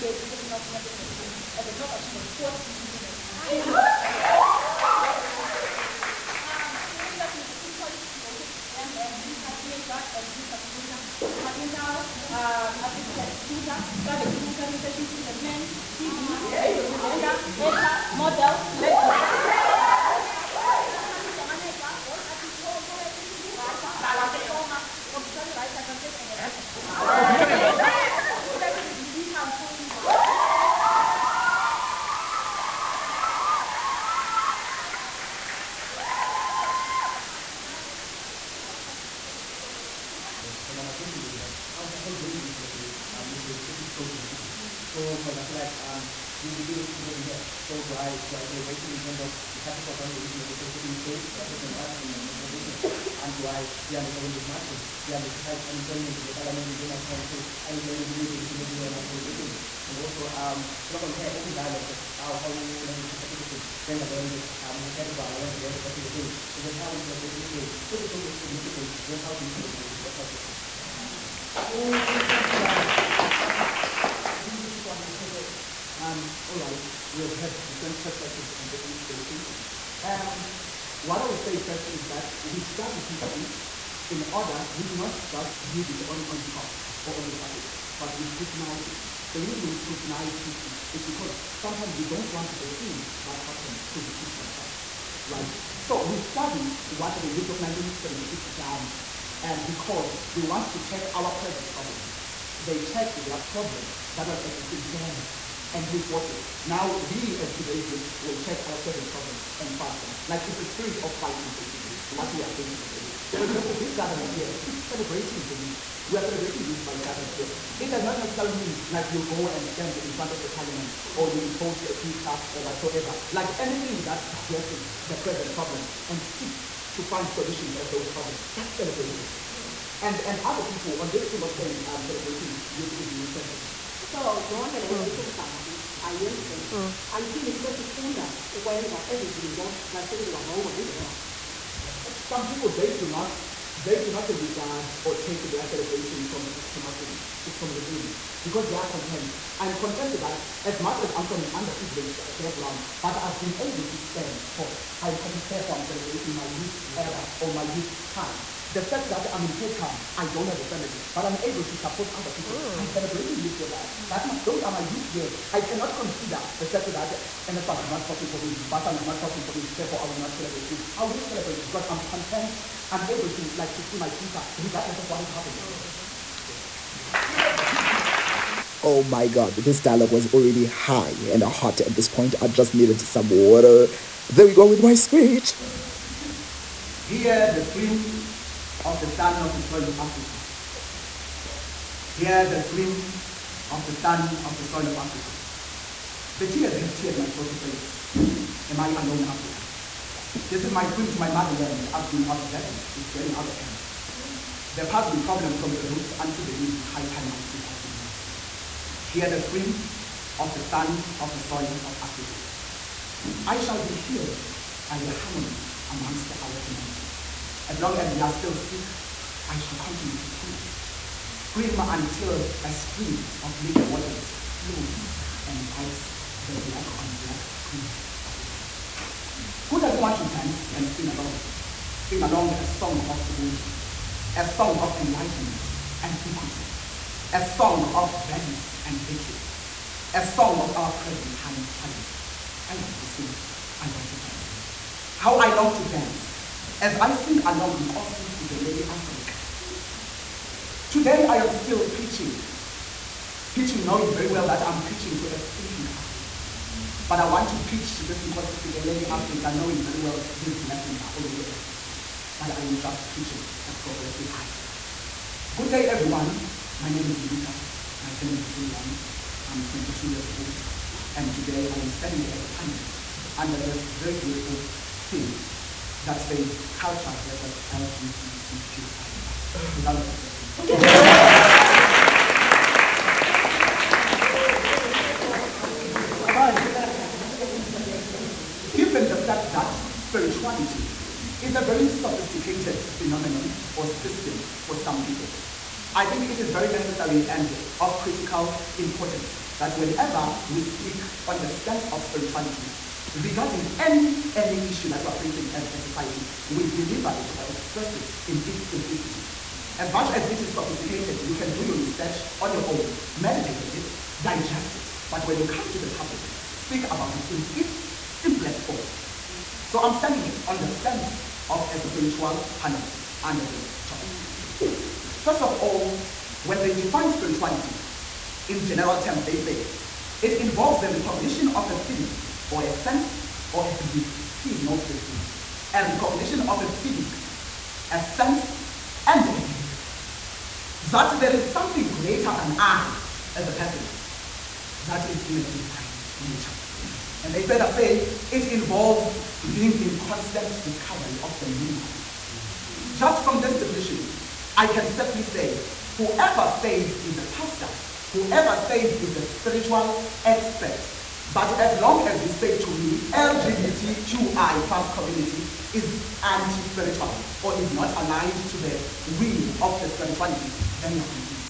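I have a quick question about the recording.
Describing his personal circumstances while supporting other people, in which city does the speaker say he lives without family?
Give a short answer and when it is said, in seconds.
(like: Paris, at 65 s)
Cape Town, at 159 s.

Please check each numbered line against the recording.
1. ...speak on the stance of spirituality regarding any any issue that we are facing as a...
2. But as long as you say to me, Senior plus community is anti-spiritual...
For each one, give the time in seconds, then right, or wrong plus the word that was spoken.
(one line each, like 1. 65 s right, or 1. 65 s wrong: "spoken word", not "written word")
1. 300 s right
2. 361 s wrong: "LGBTQI", not "Senior".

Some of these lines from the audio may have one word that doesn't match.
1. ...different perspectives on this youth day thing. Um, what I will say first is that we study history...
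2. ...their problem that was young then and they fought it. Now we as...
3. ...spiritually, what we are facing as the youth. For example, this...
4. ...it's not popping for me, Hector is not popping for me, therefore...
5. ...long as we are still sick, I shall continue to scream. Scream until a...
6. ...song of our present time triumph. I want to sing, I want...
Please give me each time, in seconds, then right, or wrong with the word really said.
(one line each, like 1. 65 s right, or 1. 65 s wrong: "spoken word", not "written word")
1. 77 s right
2. 103 s wrong: "existing", not "young"
3. 111 s wrong: "basically", not "spiritually"
4. 167 s wrong: "Basan", not "Hector"
5. 217 s right
6. 240 s right.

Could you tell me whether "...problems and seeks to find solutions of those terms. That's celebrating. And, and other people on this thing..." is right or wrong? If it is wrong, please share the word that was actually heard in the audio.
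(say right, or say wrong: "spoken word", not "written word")
wrong: "problems", not "terms".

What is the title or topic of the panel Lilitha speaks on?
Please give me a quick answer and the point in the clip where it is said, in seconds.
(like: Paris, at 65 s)
culture versus LGBTQI plus, at 276 s.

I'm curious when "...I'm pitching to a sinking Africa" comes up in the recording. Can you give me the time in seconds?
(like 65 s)
254 s.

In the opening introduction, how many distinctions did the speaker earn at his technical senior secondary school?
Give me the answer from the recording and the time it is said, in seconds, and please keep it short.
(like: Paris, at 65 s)
4, at 2 s.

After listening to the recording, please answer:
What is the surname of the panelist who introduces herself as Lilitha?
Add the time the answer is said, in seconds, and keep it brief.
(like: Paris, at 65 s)
Ntsundwani, at 268 s.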